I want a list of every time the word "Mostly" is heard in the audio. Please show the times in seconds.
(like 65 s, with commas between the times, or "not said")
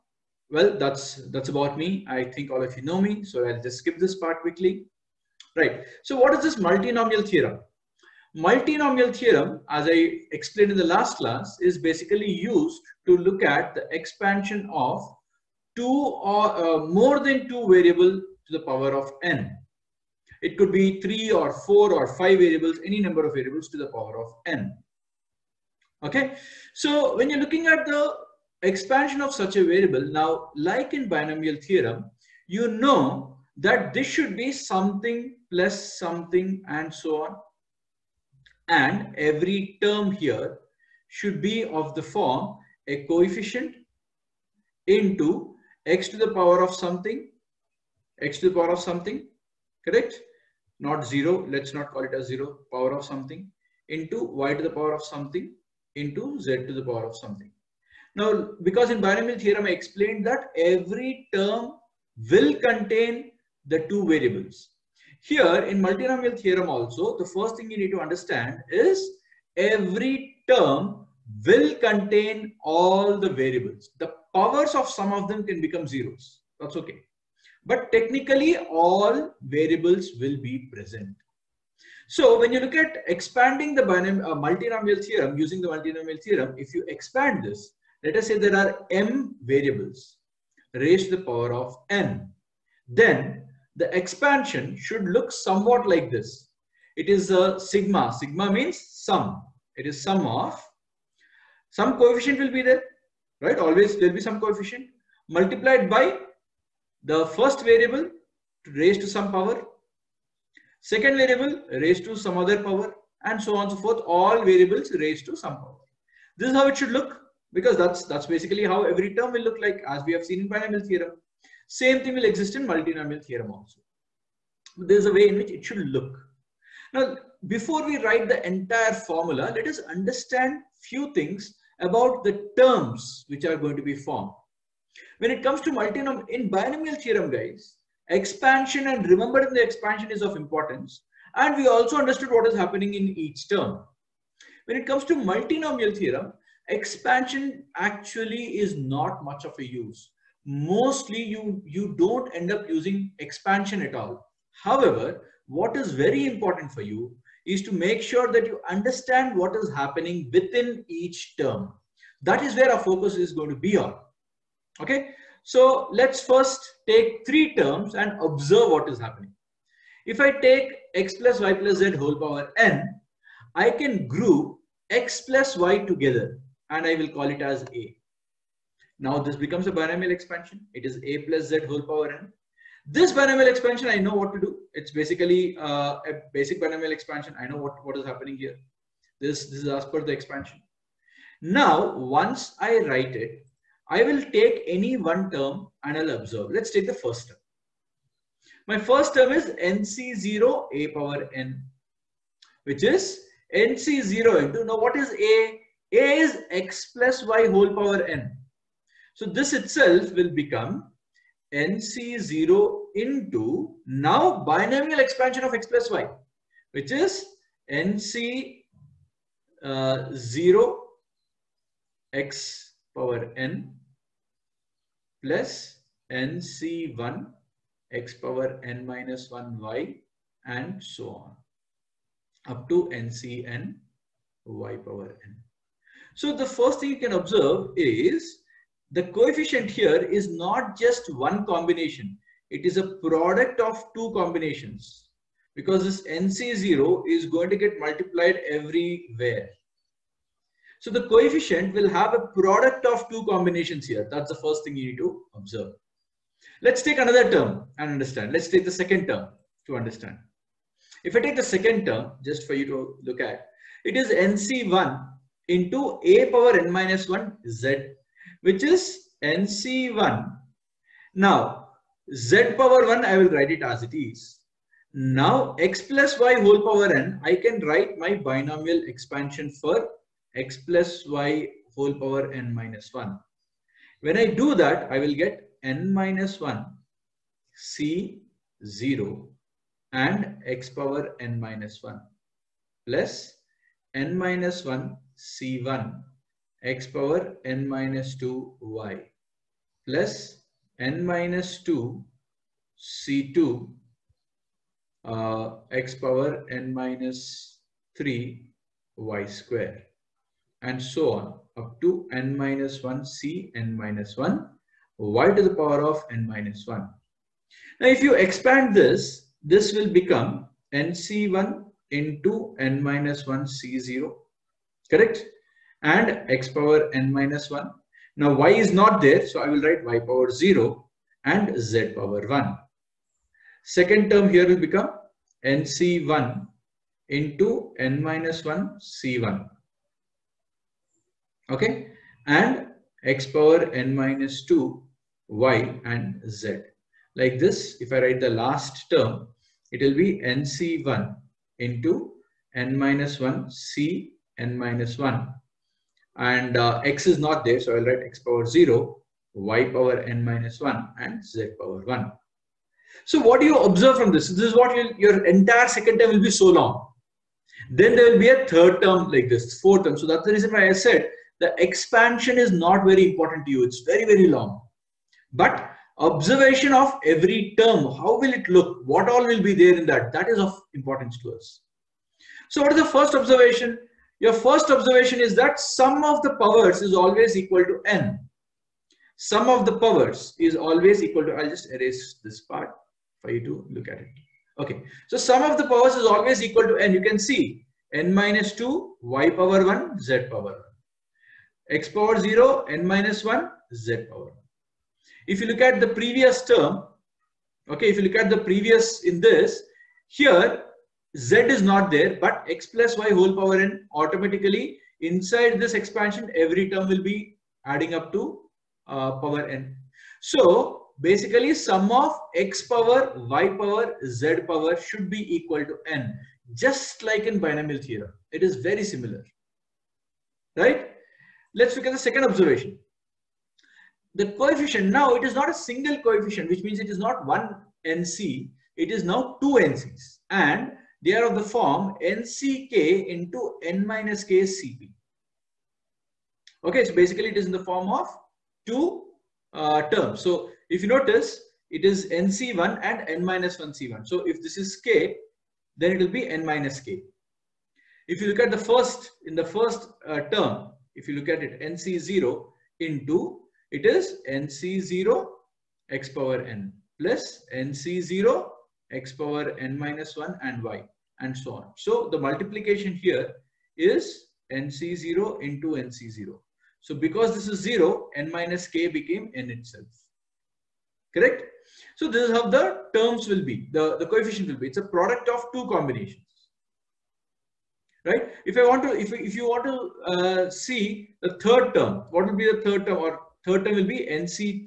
150 s.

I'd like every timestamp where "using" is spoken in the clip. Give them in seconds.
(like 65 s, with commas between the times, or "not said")
85 s, 152 s.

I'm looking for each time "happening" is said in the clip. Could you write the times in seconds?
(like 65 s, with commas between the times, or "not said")
142 s, 159 s, 168 s, 188 s.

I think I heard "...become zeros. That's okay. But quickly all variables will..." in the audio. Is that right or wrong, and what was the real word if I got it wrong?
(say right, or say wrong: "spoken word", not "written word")
wrong: "technically", not "quickly".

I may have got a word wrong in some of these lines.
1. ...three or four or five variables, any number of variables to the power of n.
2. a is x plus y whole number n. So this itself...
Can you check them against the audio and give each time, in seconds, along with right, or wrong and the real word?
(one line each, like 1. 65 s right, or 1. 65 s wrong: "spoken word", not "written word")
1. 21 s right
2. 205 s wrong: "power", not "number".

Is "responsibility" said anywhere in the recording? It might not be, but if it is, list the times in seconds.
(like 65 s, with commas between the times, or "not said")
not said.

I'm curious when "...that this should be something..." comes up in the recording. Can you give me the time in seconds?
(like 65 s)
33 s.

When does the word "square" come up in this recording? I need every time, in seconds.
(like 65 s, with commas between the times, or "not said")
309 s.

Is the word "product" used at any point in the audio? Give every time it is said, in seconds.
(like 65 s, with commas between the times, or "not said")
243 s, 252 s, 484 s.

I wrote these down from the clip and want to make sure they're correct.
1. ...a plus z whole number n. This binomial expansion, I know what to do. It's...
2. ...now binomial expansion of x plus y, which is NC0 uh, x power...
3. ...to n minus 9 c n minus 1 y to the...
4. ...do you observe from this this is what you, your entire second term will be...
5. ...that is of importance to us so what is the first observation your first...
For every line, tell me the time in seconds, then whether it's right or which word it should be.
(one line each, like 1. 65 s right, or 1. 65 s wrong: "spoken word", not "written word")
1. 181 s wrong: "power", not "number"
2. 213 s right
3. 311 s wrong: "1", not "9"
4. 363 s right
5. 380 s right.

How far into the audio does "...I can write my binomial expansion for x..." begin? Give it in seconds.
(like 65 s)
277 s.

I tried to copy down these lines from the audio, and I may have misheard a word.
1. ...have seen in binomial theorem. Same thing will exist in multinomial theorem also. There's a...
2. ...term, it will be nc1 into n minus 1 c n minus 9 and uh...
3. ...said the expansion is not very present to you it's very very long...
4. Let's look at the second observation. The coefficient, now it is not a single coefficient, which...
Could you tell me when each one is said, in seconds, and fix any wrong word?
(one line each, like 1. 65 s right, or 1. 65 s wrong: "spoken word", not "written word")
1. 120 s right
2. 348 s wrong: "1", not "9"
3. 370 s wrong: "important", not "present"
4. 431 s right.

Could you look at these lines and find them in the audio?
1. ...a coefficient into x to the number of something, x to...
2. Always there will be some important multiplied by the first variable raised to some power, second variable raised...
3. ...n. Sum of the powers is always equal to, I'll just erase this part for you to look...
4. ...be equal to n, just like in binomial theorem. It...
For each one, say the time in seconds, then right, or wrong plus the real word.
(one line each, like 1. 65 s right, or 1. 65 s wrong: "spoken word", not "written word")
1. 42 s wrong: "power", not "number"
2. 103 s wrong: "coefficient", not "important"
3. 387 s right
4. 425 s right.